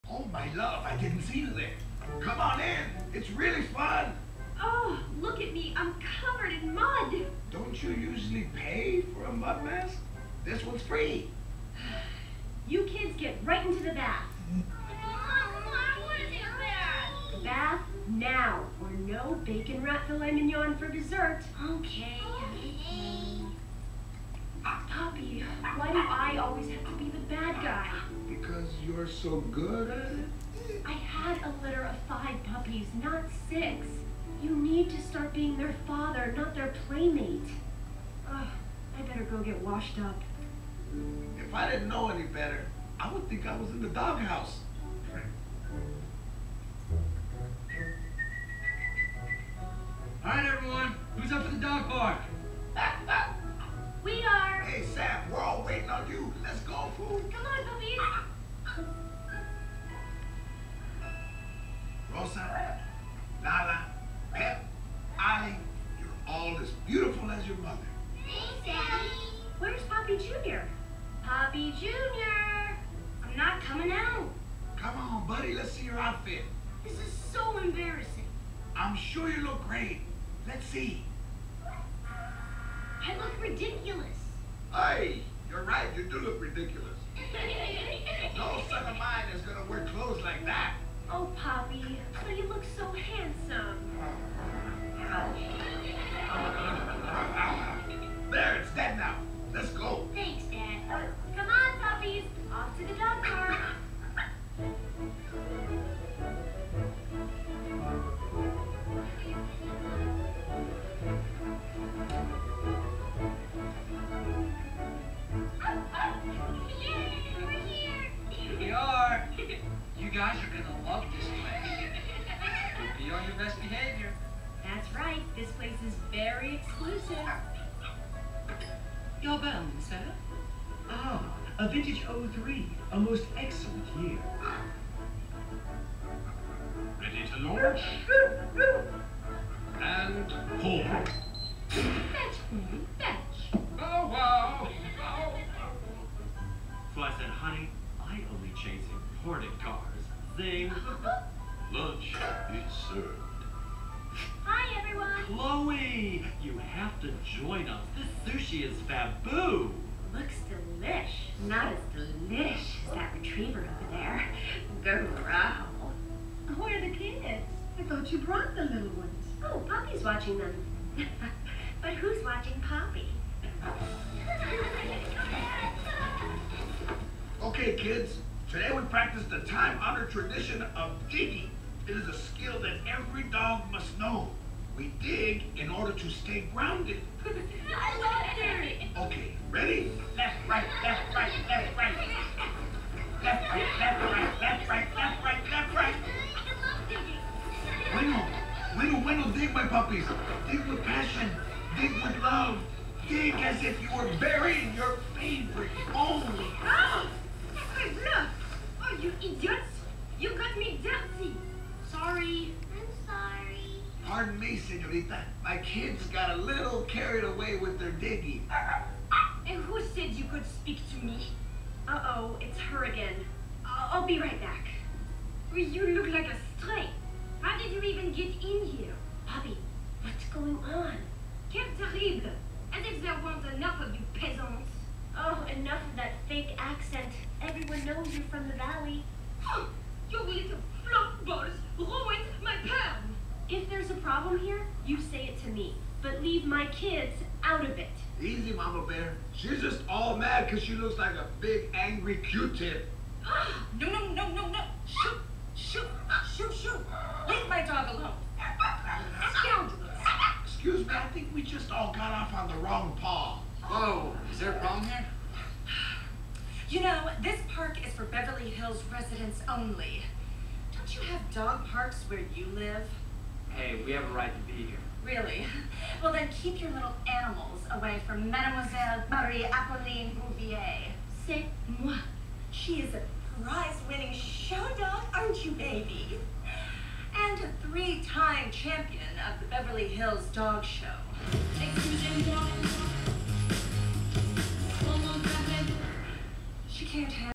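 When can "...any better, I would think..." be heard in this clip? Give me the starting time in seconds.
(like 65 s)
42 s.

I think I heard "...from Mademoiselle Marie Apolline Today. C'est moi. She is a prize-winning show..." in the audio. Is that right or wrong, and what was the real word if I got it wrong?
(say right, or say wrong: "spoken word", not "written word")
wrong: "Bouvier", not "Today".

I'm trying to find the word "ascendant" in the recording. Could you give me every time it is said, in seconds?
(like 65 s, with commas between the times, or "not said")
not said.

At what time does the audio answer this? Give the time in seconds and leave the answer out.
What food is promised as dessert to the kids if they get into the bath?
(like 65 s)
19 s.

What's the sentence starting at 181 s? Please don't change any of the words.
It is a skill that every dog must know.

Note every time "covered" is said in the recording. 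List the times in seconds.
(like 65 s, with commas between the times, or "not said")
6 s.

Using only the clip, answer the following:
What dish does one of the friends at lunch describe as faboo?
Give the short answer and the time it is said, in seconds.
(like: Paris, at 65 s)
Sushi, at 158 s.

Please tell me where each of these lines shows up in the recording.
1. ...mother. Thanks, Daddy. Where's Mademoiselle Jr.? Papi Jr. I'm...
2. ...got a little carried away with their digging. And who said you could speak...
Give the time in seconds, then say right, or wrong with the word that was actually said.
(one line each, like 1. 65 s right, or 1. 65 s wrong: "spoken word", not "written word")
1. 67 s wrong: "Papi", not "Mademoiselle"
2. 216 s right.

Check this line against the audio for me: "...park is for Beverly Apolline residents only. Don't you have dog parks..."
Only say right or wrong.
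wrong.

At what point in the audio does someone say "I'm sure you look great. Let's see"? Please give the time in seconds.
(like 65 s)
78 s.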